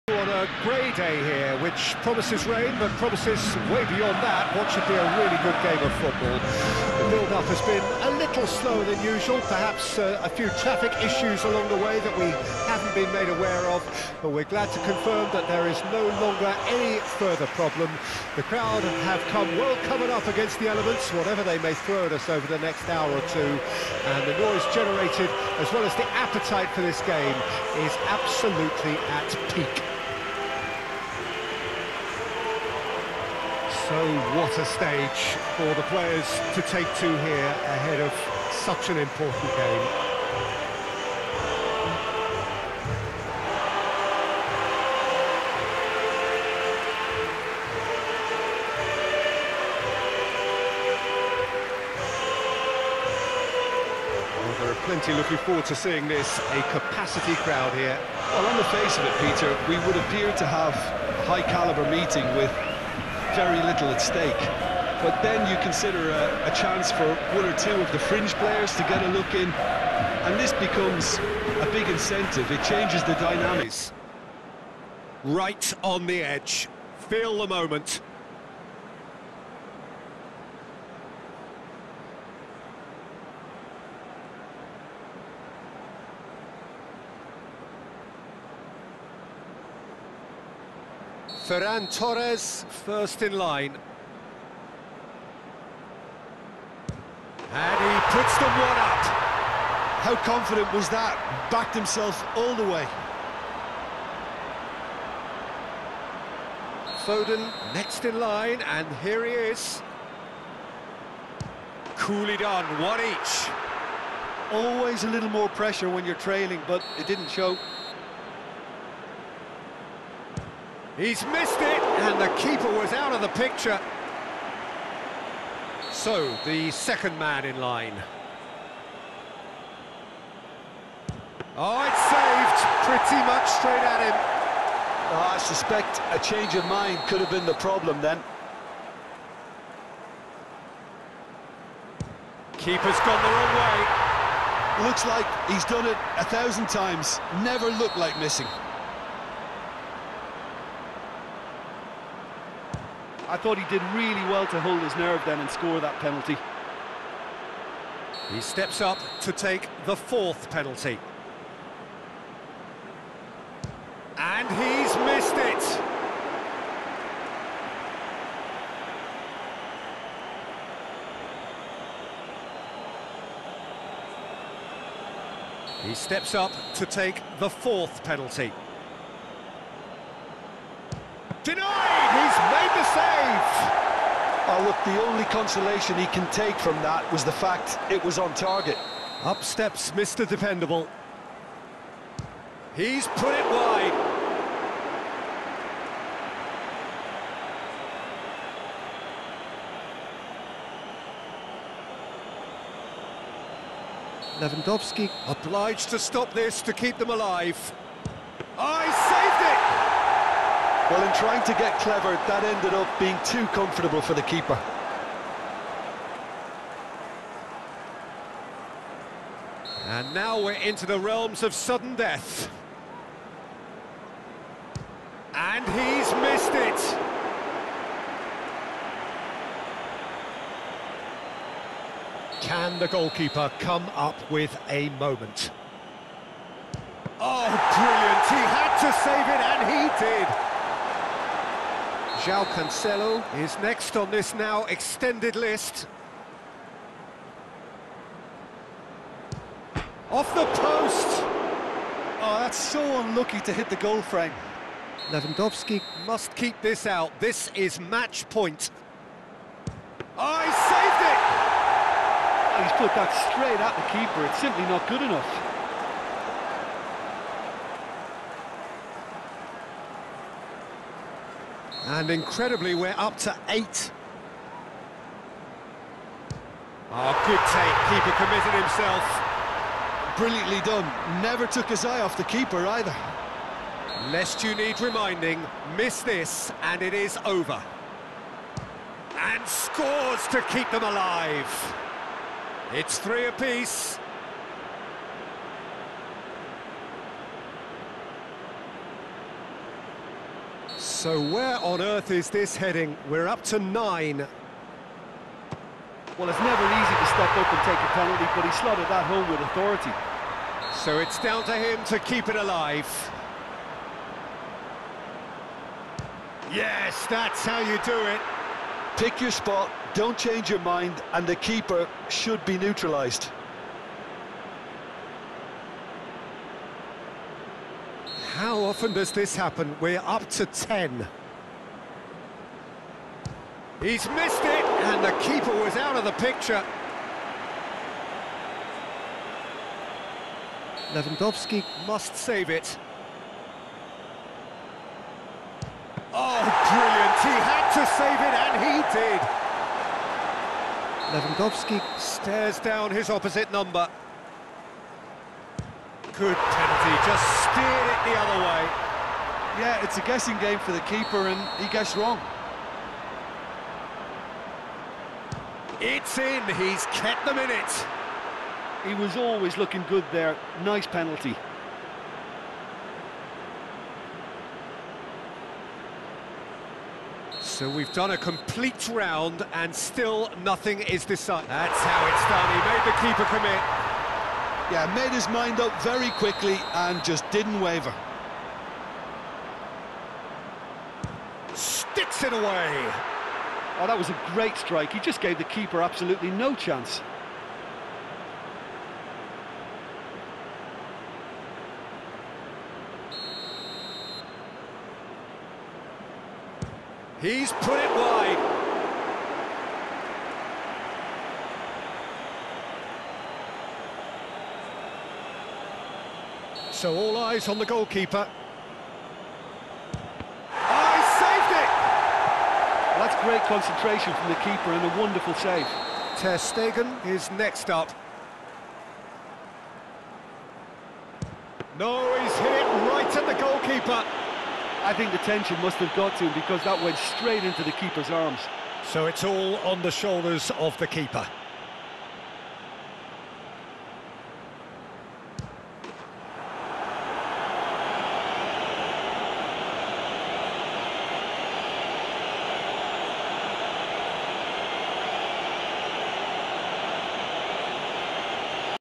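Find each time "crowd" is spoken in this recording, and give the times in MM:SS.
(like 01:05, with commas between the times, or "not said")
00:18, 00:57.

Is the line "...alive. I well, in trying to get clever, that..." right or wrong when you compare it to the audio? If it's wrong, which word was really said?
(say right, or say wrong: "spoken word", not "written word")
right.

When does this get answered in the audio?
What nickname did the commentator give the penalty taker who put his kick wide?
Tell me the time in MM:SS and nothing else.
03:09.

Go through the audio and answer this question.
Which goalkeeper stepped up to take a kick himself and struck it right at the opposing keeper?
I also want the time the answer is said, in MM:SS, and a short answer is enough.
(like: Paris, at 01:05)
Ter Stegen, at 07:06.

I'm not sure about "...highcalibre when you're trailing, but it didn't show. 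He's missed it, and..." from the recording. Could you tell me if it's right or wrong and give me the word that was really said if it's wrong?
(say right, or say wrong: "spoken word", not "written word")
wrong: "pressure", not "highcalibre".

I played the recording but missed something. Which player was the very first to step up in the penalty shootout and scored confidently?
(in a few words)
Ferran Torres.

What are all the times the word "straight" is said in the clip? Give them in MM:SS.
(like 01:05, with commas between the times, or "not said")
02:13, 04:23, 07:16.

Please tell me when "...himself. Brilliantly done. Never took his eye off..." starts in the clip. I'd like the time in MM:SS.
04:38.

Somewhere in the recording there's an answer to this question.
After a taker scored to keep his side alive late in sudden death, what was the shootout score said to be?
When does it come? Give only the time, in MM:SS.
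04:52.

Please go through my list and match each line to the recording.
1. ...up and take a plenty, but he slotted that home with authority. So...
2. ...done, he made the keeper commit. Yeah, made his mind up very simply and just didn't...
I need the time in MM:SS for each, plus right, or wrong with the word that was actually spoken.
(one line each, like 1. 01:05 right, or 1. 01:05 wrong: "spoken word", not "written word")
1. 05:07 wrong: "penalty", not "plenty"
2. 06:22 wrong: "quickly", not "simply".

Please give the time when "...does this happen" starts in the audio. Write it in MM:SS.
05:28.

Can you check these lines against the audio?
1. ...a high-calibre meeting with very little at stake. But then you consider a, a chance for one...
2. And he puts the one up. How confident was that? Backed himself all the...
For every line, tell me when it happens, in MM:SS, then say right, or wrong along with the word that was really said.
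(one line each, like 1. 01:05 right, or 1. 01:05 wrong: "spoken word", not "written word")
1. 01:00 right
2. 01:37 right.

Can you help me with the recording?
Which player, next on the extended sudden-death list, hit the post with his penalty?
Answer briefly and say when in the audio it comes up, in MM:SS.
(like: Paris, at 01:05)
João Cancelo, at 04:02.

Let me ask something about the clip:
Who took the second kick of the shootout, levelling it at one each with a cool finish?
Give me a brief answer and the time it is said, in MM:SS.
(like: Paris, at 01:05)
Foden, at 01:47.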